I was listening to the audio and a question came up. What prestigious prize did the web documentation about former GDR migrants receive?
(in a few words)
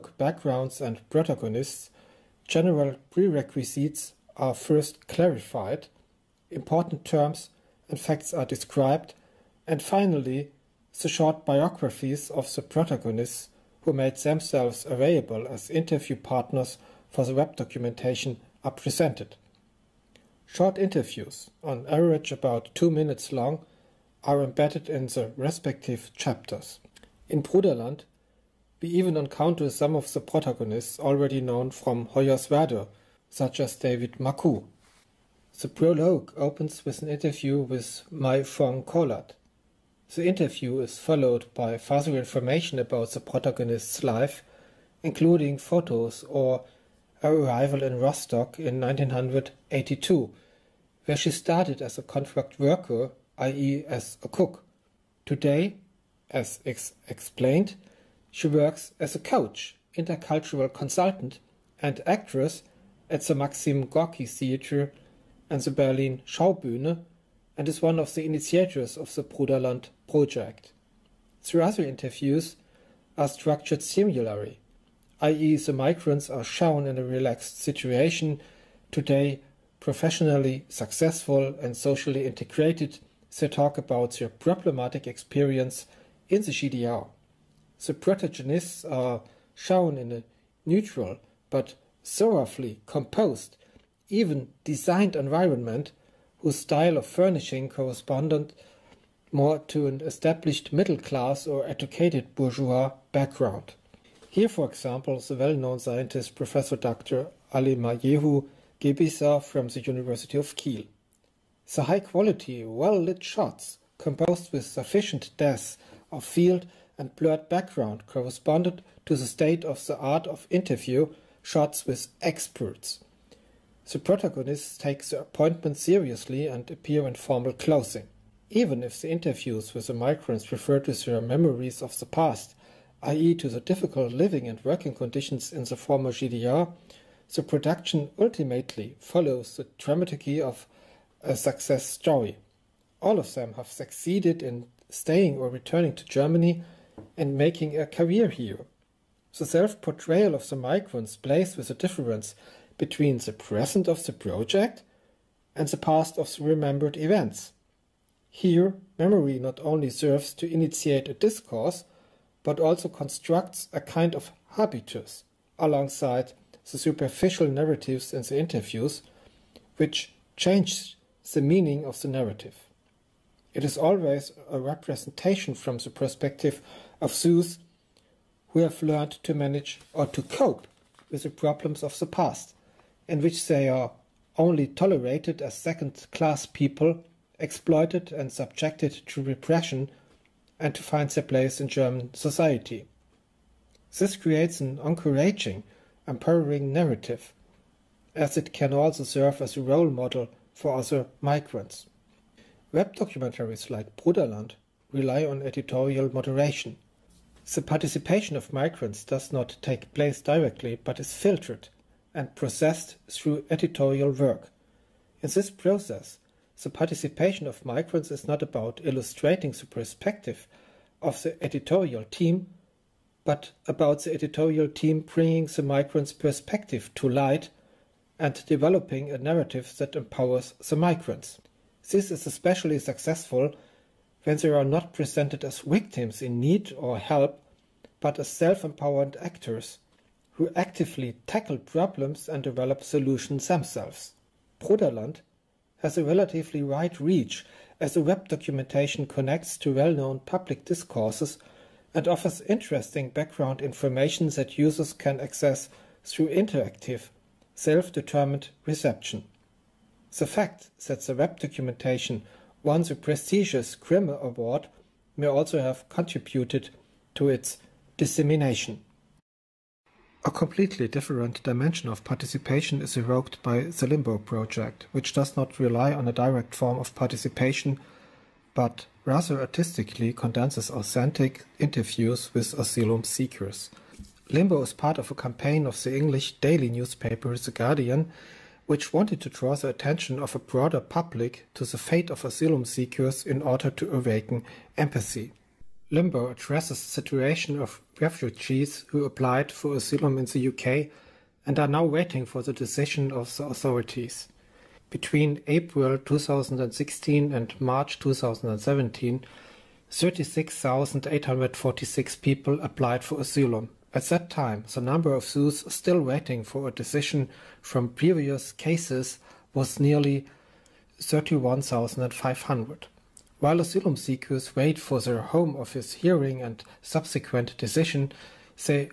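Grimme Award.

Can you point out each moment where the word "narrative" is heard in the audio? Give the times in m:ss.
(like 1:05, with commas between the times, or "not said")
2:47, 2:52, 3:16, 3:49.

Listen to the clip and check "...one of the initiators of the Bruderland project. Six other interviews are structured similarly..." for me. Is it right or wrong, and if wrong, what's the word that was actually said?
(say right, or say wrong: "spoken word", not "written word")
wrong: "Three", not "Six".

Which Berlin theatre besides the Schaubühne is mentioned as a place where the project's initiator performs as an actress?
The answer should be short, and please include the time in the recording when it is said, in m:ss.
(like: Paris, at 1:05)
Maxim Gorky Theatre, at 1:03.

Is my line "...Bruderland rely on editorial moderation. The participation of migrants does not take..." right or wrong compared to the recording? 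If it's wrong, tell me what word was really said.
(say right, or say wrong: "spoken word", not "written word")
right.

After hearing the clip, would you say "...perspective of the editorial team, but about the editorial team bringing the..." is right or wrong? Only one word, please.
right.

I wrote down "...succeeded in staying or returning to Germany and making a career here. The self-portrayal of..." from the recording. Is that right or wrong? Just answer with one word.
right.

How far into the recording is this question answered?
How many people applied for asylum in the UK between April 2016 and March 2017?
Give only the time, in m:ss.
5:09.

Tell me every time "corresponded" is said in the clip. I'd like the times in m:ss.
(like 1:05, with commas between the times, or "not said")
1:37, 1:58.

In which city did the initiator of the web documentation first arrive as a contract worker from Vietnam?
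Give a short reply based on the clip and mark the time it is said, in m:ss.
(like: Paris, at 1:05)
Rostock, at 0:47.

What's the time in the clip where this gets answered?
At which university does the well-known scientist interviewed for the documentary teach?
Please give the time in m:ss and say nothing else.
1:49.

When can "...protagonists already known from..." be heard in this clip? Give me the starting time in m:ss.
0:30.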